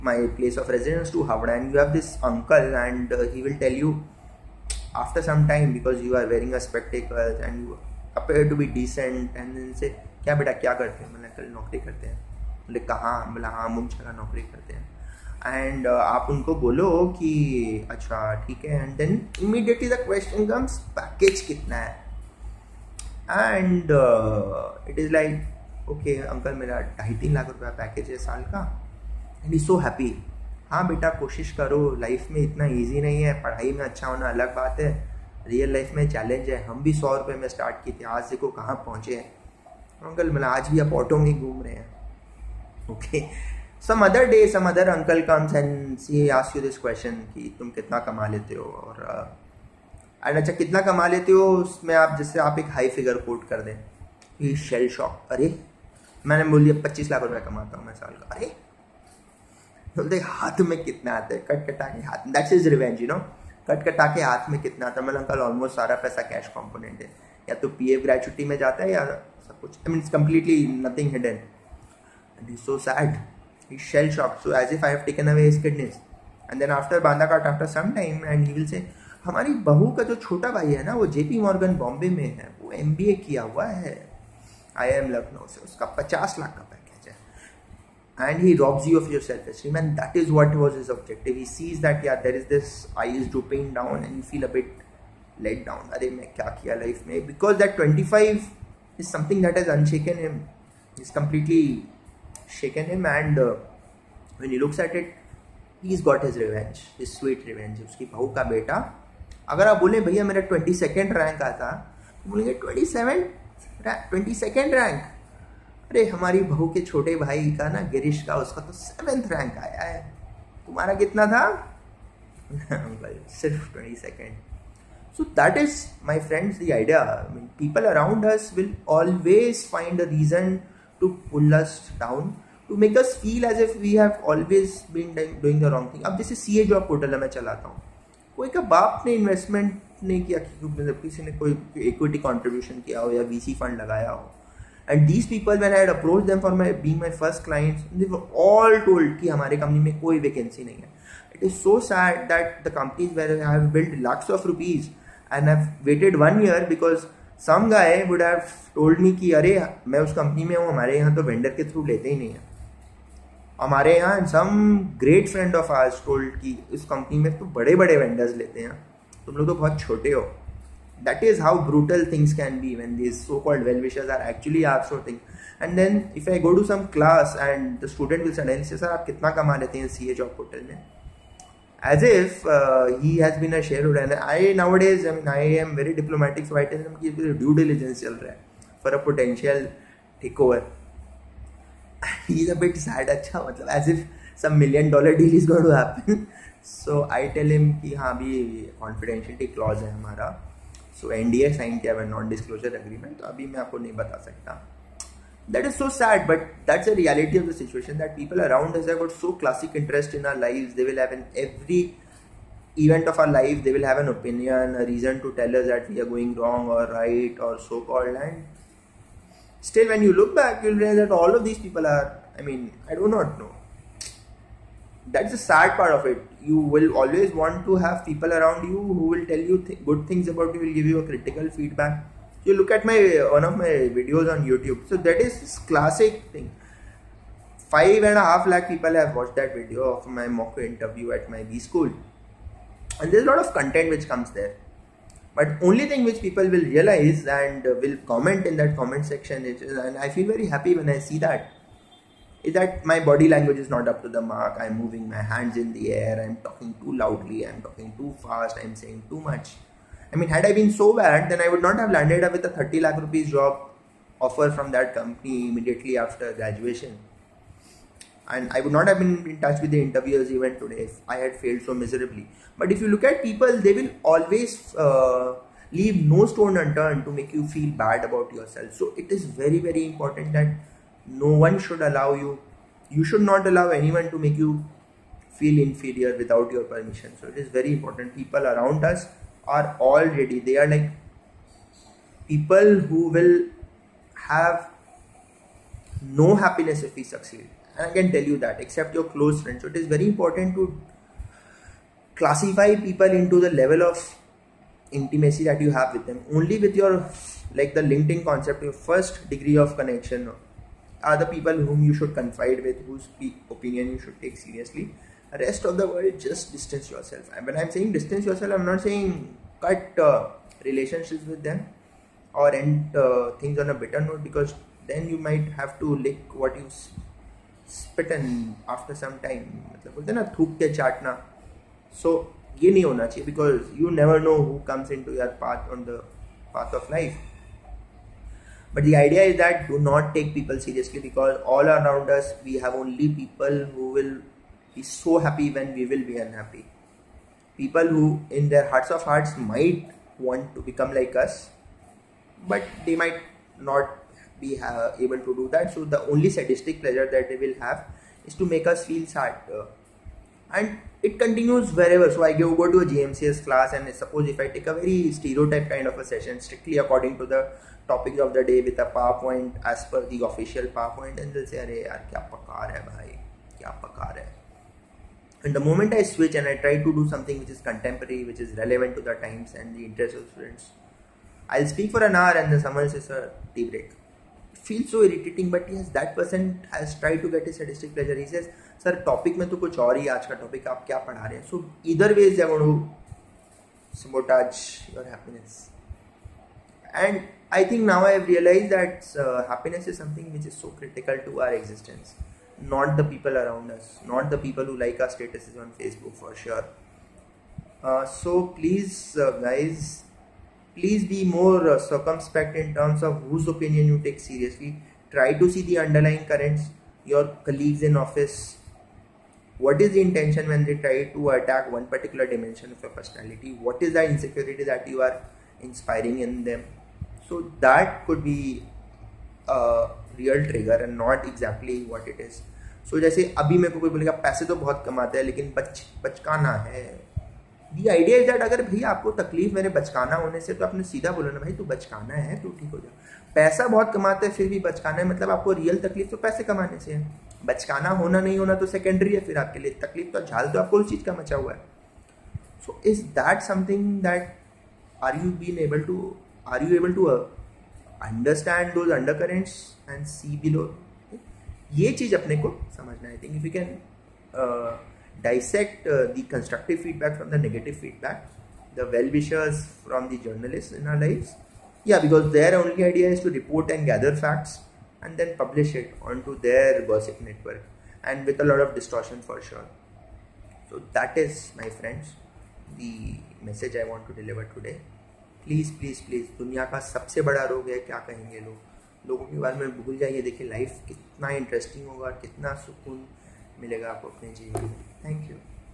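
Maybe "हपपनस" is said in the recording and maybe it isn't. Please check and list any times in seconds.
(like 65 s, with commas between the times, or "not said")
395 s, 399 s.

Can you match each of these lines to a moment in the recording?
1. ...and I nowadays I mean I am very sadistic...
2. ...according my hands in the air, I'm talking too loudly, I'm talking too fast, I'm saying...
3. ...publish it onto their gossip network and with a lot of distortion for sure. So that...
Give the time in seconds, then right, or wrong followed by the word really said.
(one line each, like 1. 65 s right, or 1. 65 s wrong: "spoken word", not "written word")
1. 183 s wrong: "diplomatic", not "sadistic"
2. 254 s wrong: "moving", not "according"
3. 475 s right.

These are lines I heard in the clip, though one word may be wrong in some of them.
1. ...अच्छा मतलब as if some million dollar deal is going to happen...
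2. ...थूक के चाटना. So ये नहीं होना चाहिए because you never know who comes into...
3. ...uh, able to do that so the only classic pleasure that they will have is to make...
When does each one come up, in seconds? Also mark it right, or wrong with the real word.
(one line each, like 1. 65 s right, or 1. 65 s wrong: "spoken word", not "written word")
1. 193 s right
2. 330 s right
3. 354 s wrong: "sadistic", not "classic".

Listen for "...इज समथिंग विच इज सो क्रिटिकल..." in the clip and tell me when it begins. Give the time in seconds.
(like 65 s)
399 s.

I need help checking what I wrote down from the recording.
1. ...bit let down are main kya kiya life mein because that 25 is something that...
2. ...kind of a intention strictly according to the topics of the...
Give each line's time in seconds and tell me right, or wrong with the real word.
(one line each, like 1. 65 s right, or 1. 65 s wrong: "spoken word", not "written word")
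1. 94 s right
2. 365 s wrong: "session", not "intention".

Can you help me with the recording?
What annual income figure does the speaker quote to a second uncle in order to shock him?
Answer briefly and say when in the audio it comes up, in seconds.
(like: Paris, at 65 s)
25 lakh rupees, at 56 s.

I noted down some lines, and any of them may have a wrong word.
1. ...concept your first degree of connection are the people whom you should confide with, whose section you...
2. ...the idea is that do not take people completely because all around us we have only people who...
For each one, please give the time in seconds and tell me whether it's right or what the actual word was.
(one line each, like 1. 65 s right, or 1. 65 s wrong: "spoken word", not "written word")
1. 308 s wrong: "opinion", not "section"
2. 338 s wrong: "seriously", not "completely".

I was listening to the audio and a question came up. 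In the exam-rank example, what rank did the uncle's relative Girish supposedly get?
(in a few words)
7th.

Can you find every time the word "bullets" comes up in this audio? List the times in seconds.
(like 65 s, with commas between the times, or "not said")
not said.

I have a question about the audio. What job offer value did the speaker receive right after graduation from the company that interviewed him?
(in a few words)
30 lakh rupees.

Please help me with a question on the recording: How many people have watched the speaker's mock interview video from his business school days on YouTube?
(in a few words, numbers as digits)
5.5 lakh.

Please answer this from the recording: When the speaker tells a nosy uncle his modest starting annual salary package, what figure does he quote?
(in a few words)
2.5-3 lakh rupees.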